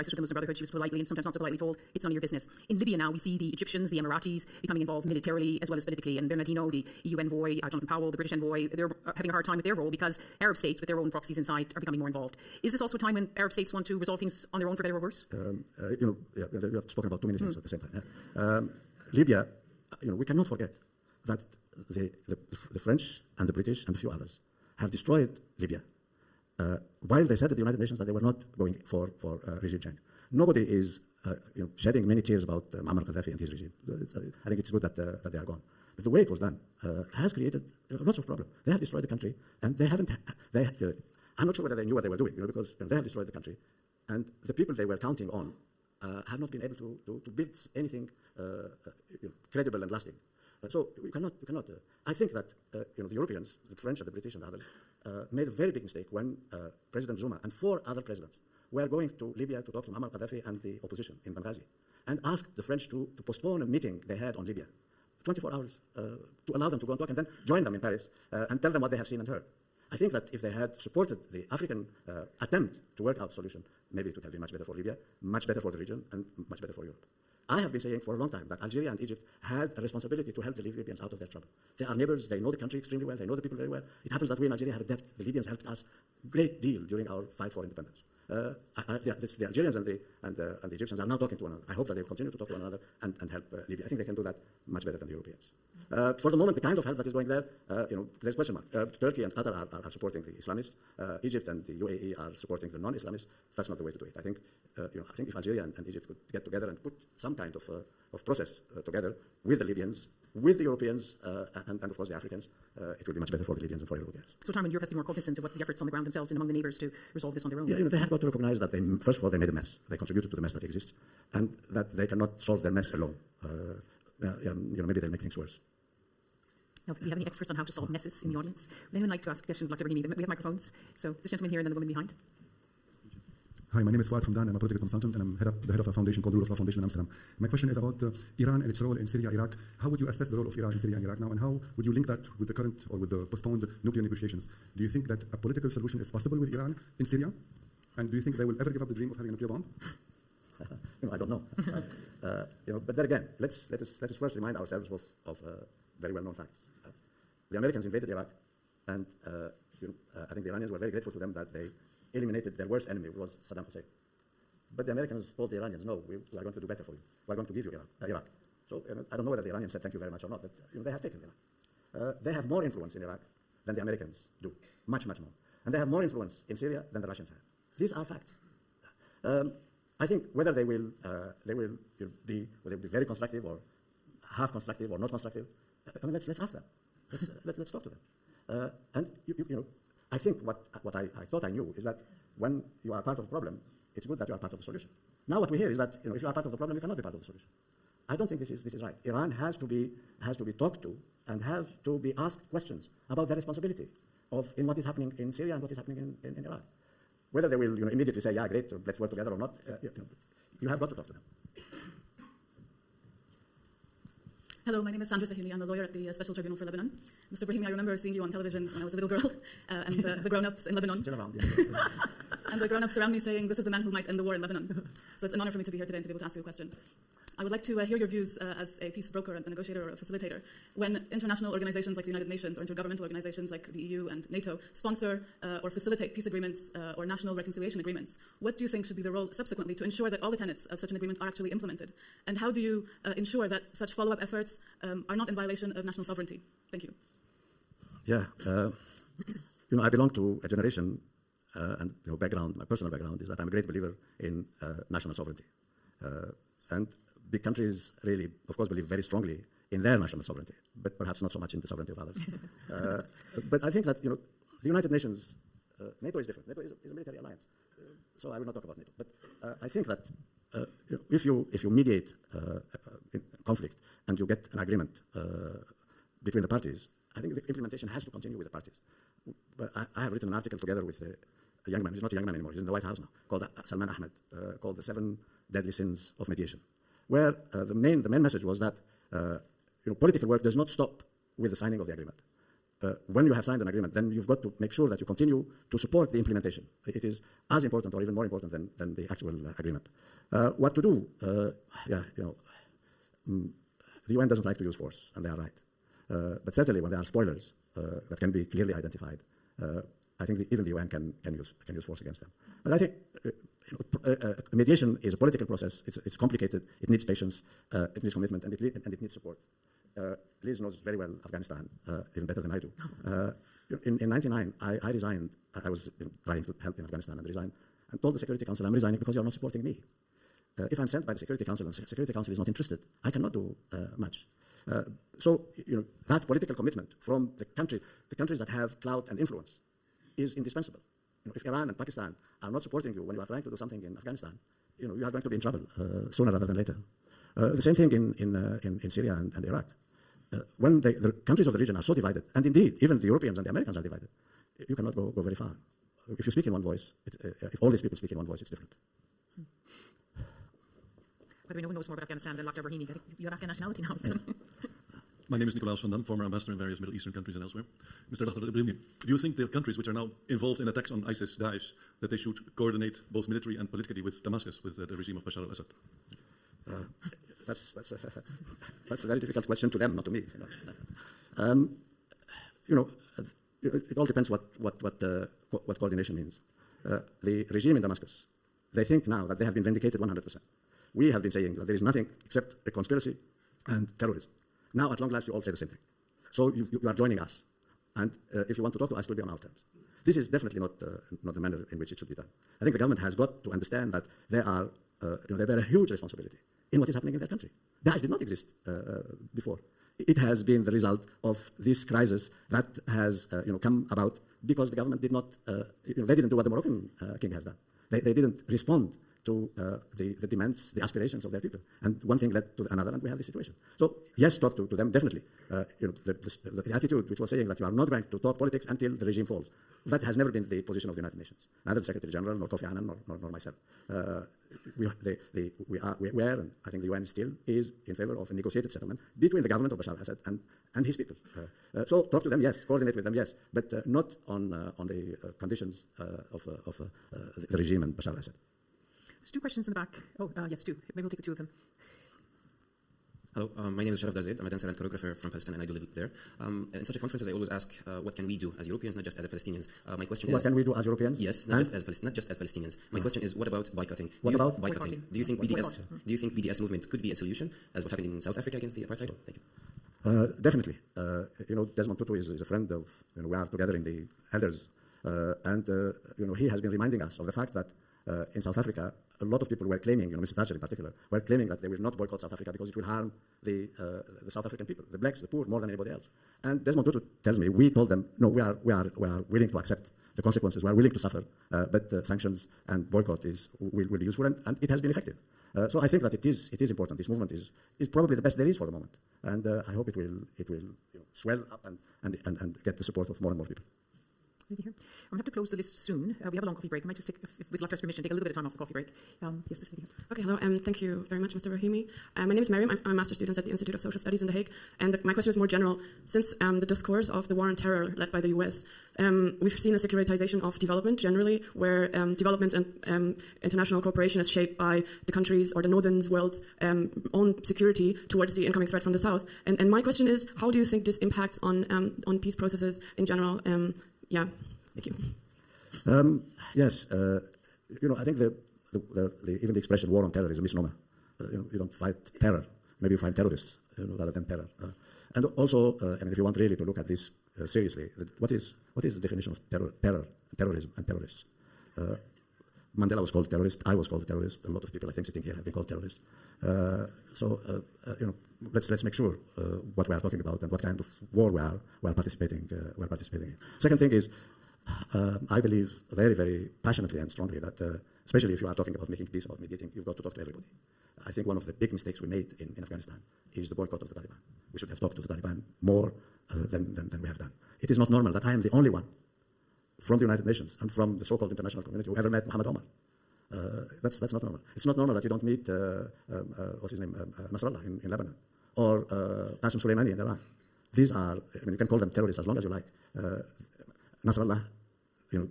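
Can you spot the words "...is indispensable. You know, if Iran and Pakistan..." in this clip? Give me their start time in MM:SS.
05:40.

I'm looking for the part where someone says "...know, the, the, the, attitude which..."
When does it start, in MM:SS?
07:05.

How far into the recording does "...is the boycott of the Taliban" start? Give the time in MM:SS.
09:33.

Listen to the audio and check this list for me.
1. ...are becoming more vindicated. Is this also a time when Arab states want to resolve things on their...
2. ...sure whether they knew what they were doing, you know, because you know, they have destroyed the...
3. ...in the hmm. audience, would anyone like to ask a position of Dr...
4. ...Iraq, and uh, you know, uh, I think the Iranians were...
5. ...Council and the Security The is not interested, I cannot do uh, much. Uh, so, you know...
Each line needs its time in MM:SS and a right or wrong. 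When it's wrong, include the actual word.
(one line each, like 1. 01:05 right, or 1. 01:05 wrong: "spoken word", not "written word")
1. 00:11 wrong: "involved", not "vindicated"
2. 00:41 right
3. 02:08 wrong: "question", not "position"
4. 02:38 right
5. 05:31 wrong: "Council", not "The".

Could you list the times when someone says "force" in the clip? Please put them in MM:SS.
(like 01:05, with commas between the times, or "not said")
05:04, 05:11.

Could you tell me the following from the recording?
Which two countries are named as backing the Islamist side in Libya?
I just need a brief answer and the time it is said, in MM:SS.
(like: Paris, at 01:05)
Turkey and Qatar, at 01:39.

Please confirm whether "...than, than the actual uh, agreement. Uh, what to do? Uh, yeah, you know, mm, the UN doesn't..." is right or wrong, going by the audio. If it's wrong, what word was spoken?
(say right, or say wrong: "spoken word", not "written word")
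right.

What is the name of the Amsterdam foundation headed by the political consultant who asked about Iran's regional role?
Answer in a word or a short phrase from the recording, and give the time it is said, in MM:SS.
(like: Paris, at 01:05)
Rule of Law Foundation, at 02:16.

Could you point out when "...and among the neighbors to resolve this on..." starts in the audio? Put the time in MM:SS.
01:56.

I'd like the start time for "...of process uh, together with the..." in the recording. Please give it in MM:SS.
01:48.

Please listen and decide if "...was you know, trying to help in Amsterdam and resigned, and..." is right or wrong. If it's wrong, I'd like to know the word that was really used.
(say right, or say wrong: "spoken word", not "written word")
wrong: "Afghanistan", not "Amsterdam".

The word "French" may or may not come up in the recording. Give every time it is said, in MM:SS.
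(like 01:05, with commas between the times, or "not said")
00:22, 00:53, 01:02.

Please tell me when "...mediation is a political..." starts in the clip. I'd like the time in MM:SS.
05:14.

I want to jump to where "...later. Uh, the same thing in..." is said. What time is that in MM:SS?
05:46.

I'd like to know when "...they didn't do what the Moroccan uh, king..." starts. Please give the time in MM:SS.
06:56.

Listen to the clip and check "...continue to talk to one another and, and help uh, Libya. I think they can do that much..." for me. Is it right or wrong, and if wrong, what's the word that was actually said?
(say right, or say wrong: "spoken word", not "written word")
right.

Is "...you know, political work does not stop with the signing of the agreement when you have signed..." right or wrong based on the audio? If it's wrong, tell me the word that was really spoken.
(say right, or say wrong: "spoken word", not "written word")
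right.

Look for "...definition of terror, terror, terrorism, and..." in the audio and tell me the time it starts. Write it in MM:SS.
09:08.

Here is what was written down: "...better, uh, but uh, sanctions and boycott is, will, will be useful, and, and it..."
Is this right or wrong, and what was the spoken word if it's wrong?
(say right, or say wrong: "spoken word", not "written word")
wrong: "suffer", not "better".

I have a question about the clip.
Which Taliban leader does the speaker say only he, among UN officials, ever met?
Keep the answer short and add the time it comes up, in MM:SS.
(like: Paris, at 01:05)
Muhammad Omar, at 09:42.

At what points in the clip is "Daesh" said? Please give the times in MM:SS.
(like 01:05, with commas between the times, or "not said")
06:11, 06:47.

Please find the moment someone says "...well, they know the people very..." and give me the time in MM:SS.
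01:23.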